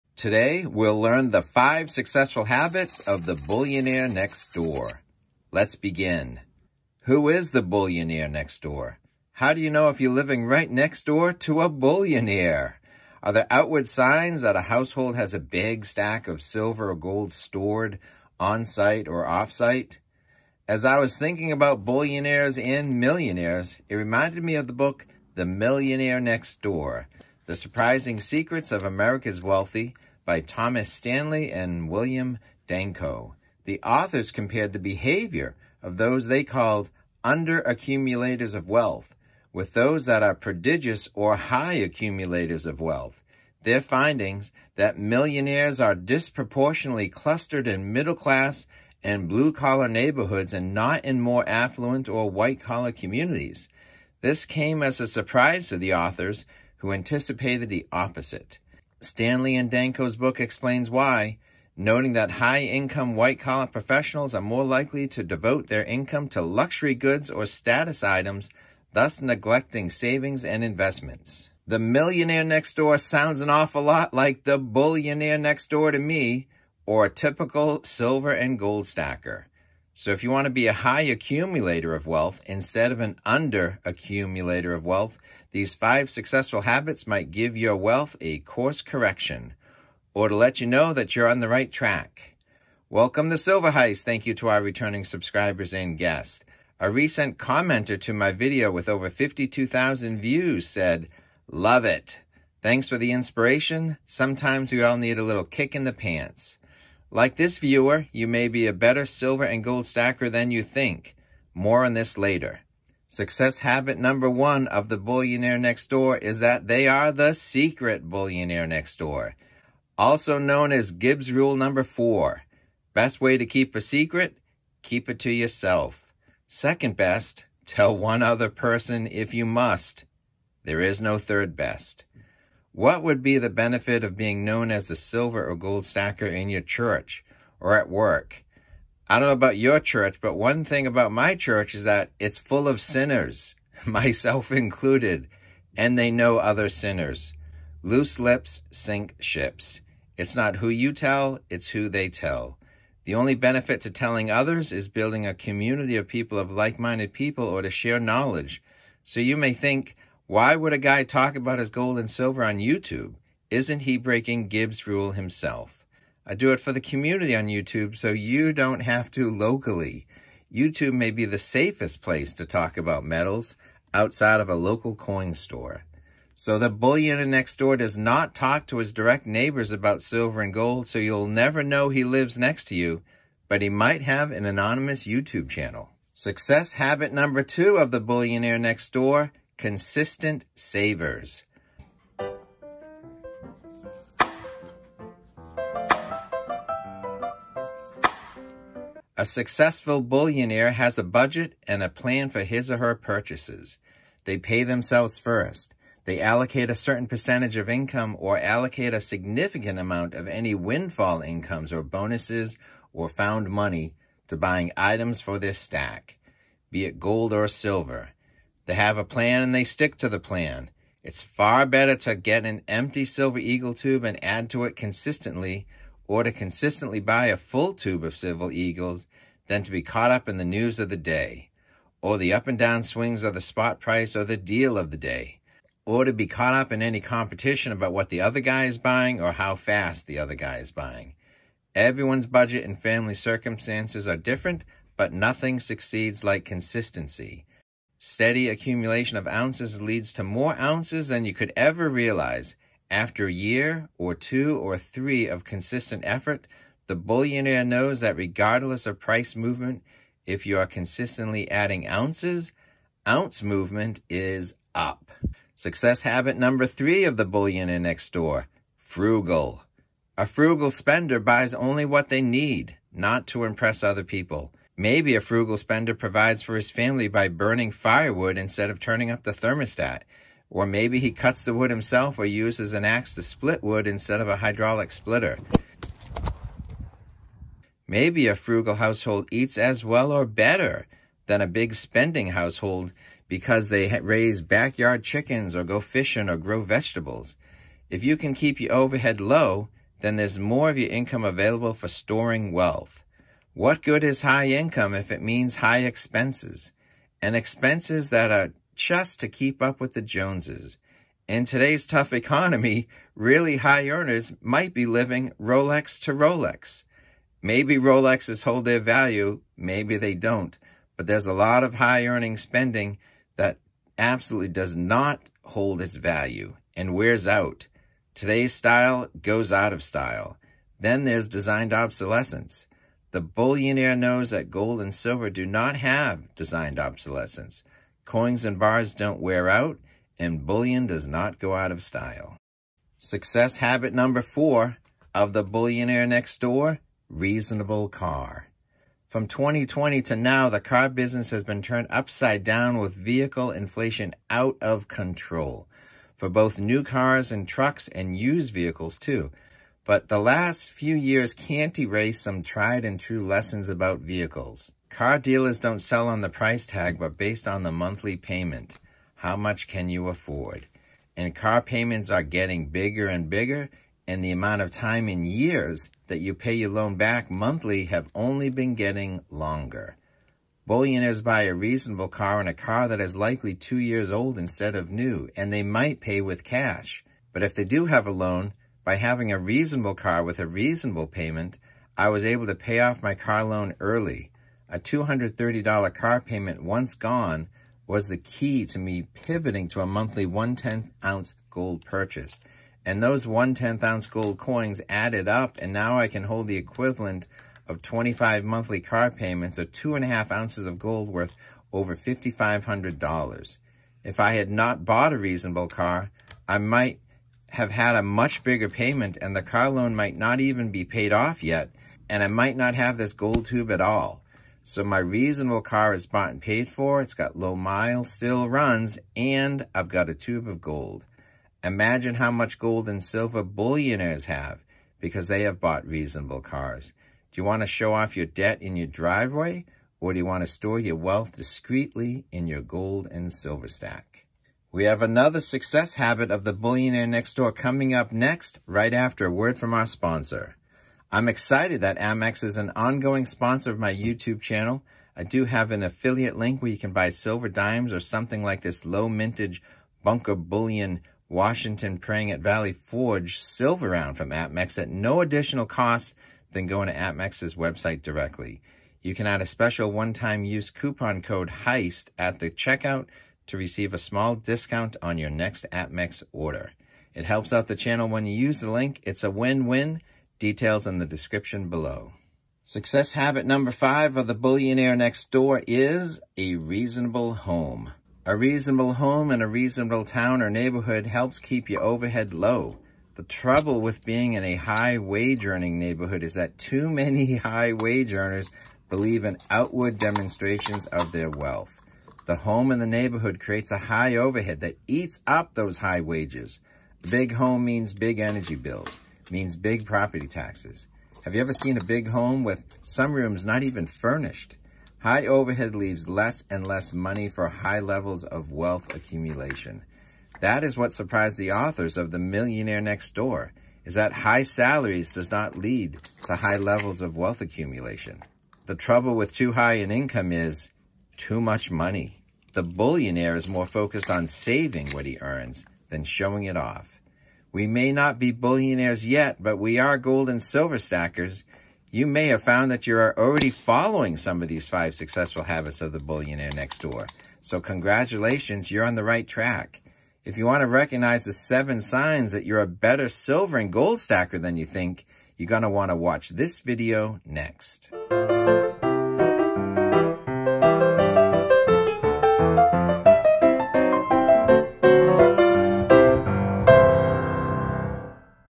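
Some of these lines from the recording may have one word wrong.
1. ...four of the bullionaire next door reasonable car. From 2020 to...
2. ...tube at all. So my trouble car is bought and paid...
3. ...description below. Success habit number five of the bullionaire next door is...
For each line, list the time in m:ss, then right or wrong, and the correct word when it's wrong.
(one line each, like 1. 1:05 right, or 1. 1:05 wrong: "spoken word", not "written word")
1. 5:44 right
2. 7:03 wrong: "reasonable", not "trouble"
3. 8:01 right.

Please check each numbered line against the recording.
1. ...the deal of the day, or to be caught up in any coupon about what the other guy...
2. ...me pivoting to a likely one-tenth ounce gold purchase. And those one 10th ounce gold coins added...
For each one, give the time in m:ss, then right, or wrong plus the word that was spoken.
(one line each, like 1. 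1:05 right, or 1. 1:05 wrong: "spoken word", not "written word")
1. 3:54 wrong: "competition", not "coupon"
2. 6:38 wrong: "monthly", not "likely".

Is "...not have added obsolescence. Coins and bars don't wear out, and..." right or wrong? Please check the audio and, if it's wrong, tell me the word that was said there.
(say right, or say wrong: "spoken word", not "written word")
wrong: "designed", not "added".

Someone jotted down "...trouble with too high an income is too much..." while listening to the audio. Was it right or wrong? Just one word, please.
right.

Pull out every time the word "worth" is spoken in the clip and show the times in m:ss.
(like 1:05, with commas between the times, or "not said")
6:51.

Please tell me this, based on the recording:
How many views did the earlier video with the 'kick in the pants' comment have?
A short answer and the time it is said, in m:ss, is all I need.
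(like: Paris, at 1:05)
52,000, at 1:39.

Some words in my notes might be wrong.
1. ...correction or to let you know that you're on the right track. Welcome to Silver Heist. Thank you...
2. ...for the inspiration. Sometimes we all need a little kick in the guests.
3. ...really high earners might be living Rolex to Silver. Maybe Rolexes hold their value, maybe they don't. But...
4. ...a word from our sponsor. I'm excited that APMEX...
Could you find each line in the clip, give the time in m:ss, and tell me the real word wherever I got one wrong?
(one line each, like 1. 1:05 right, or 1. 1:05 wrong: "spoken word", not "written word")
1. 1:28 right
2. 1:42 wrong: "pants", not "guests"
3. 5:13 wrong: "Rolex", not "Silver"
4. 7:29 right.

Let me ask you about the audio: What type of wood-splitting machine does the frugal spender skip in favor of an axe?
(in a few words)
hydraulic splitter.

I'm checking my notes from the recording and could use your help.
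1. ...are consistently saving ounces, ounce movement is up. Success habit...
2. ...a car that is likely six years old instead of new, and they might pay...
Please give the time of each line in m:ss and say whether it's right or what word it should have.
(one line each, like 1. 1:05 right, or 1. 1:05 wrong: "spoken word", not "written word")
1. 4:20 wrong: "adding", not "saving"
2. 6:22 wrong: "two", not "six".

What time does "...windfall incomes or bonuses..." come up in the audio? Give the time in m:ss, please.
3:30.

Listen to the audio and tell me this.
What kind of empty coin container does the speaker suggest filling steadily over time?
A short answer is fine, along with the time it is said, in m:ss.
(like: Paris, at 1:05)
silver eagle tube, at 3:43.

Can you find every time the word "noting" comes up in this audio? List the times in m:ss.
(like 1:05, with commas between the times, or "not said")
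1:01.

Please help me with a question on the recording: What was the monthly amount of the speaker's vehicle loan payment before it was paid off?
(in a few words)
$230.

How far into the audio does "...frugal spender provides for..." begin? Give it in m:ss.
4:35.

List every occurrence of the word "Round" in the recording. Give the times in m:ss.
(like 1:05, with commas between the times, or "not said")
7:43.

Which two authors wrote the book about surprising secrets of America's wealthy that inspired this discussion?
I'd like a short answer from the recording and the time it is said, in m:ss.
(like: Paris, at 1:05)
Thomas Stanley and William Danko, at 0:30.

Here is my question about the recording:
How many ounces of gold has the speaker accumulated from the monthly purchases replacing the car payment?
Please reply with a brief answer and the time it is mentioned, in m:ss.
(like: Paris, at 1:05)
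2.5 ounces, at 6:49.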